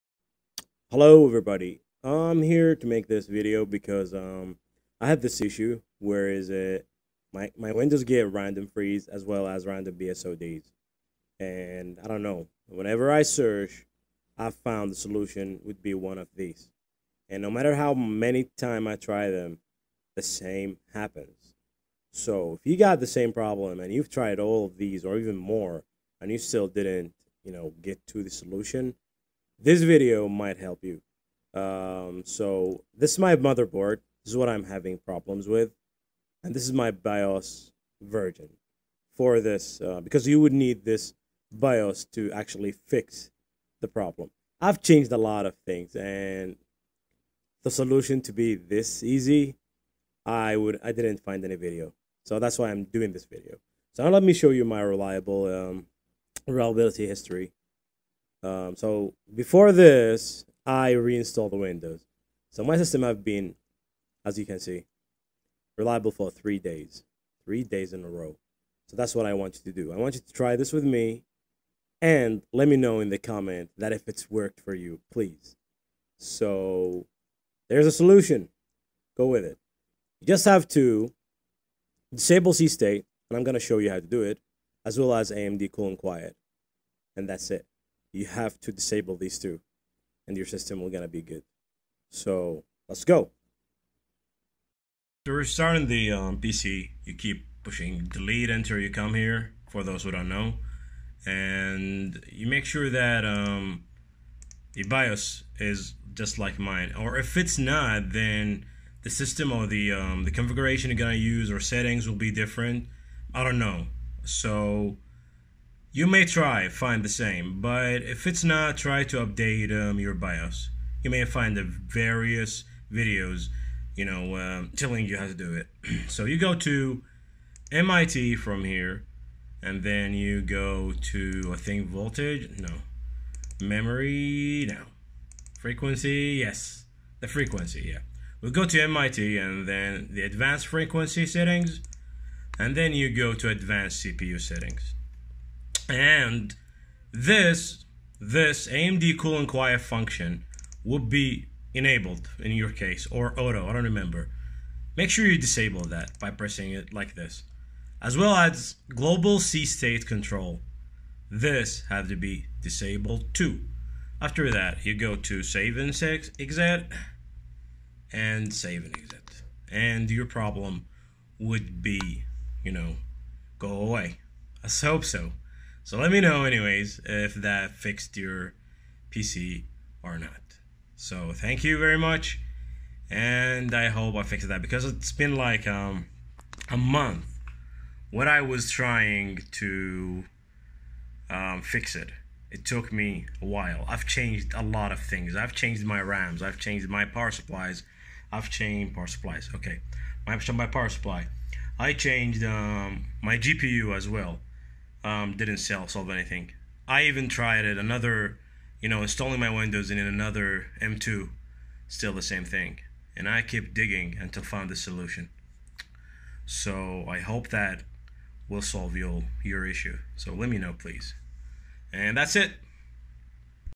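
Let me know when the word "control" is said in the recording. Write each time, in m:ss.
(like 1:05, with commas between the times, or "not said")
2:40.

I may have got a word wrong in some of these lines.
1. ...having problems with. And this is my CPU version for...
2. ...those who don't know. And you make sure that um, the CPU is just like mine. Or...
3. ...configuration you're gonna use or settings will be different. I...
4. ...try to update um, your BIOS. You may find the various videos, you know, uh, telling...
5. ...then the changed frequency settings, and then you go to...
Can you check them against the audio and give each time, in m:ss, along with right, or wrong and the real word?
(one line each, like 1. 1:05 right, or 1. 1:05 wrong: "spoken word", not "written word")
1. 0:34 wrong: "BIOS", not "CPU"
2. 1:39 wrong: "BIOS", not "CPU"
3. 1:50 right
4. 1:58 right
5. 2:19 wrong: "advanced", not "changed".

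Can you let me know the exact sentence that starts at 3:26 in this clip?
I even tried it another, you know, installing my Windows in another M2, still the same thing.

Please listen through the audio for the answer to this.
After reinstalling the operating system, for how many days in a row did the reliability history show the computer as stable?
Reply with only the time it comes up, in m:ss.
1:07.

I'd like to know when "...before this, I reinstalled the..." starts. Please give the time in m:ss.
0:59.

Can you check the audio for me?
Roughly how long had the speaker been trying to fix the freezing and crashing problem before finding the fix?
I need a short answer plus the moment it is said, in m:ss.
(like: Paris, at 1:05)
A month, at 3:06.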